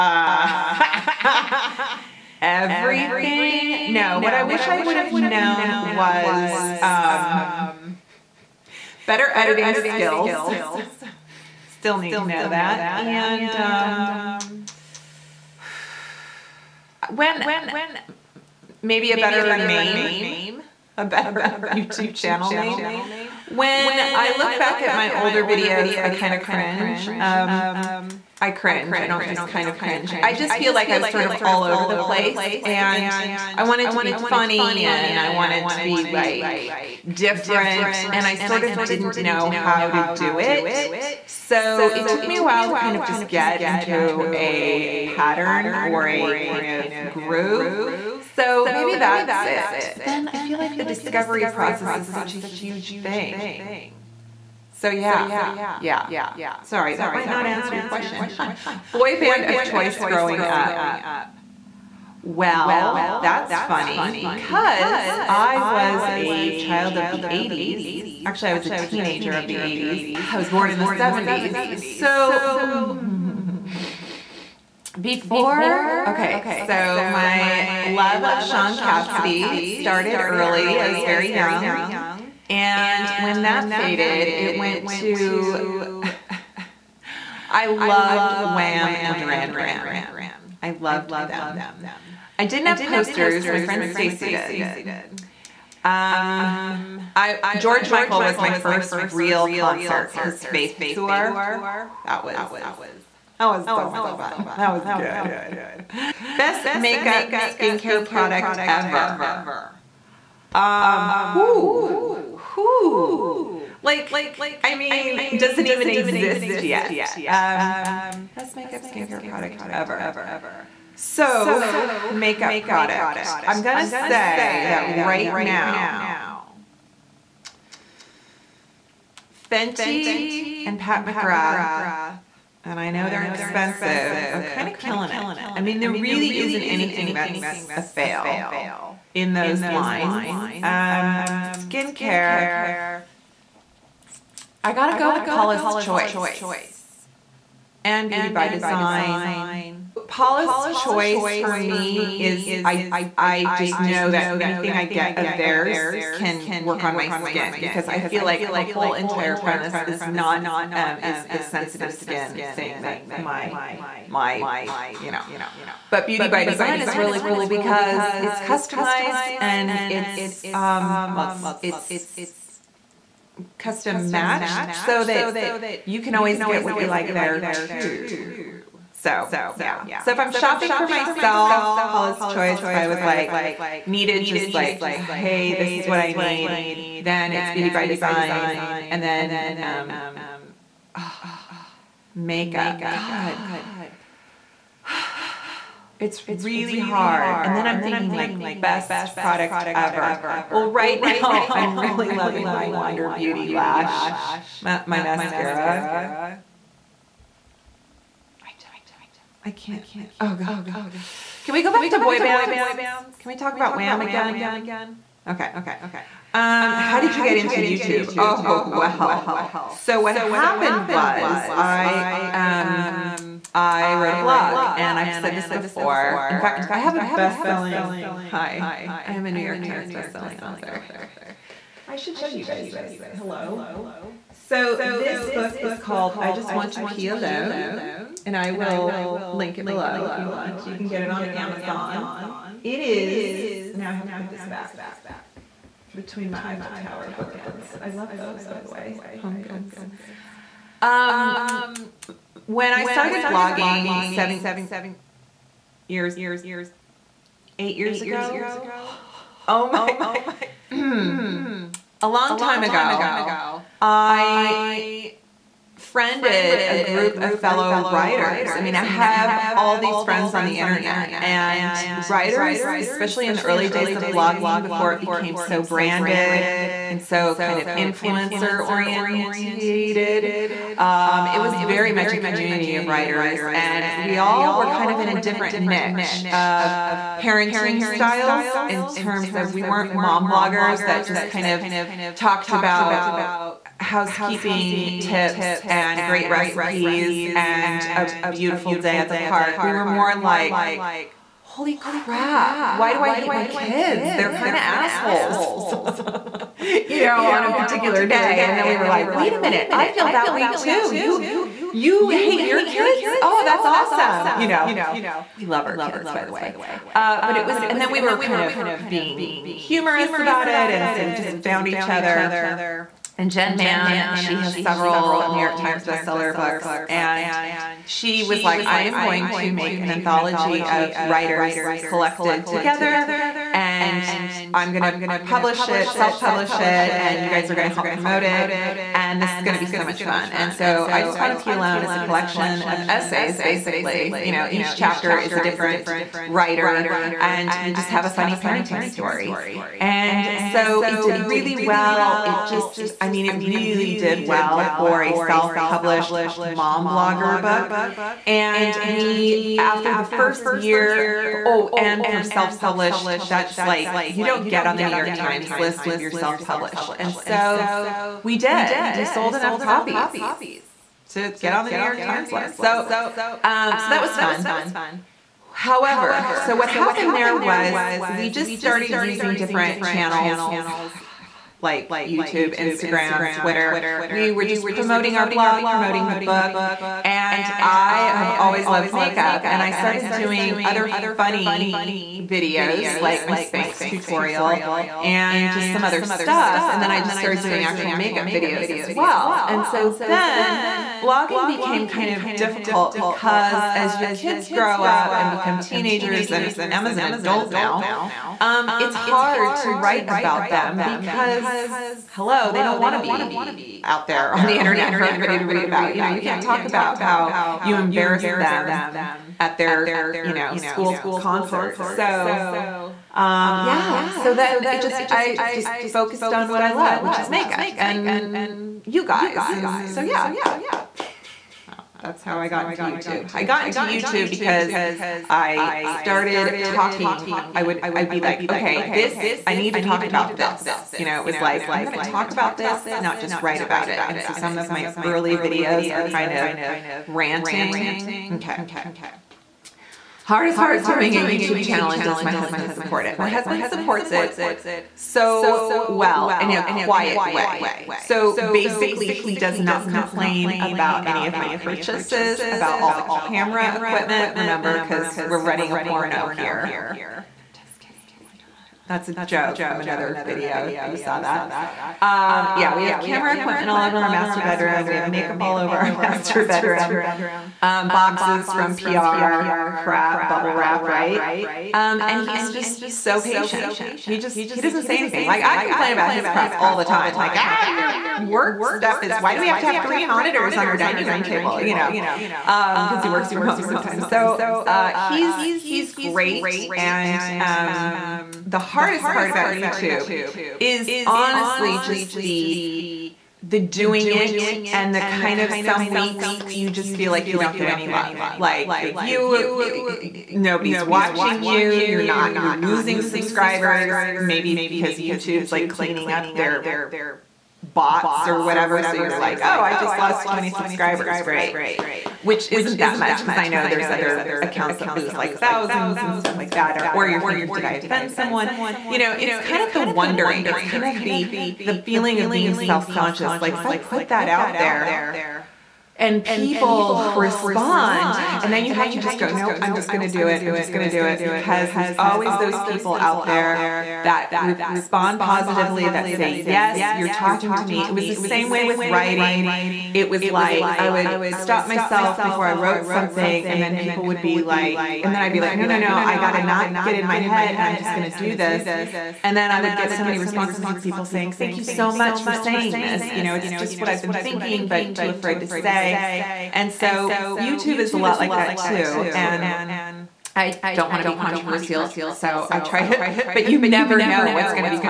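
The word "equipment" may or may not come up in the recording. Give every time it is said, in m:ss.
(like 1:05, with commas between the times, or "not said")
7:43, 7:53.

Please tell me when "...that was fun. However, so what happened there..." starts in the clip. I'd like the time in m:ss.
6:13.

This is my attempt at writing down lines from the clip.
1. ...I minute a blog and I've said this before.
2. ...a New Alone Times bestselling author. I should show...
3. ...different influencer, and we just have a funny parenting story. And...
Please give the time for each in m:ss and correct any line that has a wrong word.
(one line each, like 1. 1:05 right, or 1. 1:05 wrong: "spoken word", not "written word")
1. 3:43 wrong: "wrote", not "minute"
2. 3:49 wrong: "York", not "Alone"
3. 5:45 wrong: "writer", not "influencer".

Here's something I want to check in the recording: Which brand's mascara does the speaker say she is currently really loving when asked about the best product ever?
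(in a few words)
Wander Beauty.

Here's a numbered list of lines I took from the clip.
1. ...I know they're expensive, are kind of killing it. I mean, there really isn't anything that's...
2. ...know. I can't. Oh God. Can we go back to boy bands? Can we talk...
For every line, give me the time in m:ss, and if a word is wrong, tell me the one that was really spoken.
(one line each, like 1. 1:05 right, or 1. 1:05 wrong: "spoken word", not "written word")
1. 2:12 right
2. 3:28 right.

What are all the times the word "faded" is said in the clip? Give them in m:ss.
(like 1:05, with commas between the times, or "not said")
1:23.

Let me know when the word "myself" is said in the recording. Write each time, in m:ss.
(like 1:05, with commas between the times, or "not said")
3:00, 9:11.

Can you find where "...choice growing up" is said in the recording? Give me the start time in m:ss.
0:59.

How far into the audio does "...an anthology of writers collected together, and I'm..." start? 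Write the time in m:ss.
5:29.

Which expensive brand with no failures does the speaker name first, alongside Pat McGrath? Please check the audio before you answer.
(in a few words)
Fenty.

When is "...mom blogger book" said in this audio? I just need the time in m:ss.
5:56.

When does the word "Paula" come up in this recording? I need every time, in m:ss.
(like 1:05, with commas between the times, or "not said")
2:25, 2:30, 3:01.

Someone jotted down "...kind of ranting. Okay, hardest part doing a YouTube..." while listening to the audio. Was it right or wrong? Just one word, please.
right.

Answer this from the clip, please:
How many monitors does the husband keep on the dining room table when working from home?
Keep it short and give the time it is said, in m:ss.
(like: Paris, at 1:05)
3, at 8:09.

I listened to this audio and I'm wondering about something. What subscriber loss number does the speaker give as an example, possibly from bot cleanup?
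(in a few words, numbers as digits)
20.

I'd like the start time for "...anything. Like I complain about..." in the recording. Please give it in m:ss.
8:04.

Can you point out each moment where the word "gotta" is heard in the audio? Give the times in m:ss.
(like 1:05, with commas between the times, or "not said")
2:24, 9:16.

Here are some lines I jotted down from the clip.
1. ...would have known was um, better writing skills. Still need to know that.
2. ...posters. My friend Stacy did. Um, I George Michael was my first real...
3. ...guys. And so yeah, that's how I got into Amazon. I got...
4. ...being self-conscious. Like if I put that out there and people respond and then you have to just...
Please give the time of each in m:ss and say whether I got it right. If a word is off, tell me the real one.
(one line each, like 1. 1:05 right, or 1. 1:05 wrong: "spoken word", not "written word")
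1. 0:04 wrong: "editing", not "writing"
2. 1:32 right
3. 7:09 wrong: "YouTube", not "Amazon"
4. 8:52 right.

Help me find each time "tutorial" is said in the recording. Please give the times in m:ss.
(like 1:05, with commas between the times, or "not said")
6:33.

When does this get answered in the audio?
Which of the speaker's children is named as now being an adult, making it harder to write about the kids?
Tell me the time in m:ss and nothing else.
6:46.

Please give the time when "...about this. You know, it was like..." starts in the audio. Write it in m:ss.
7:20.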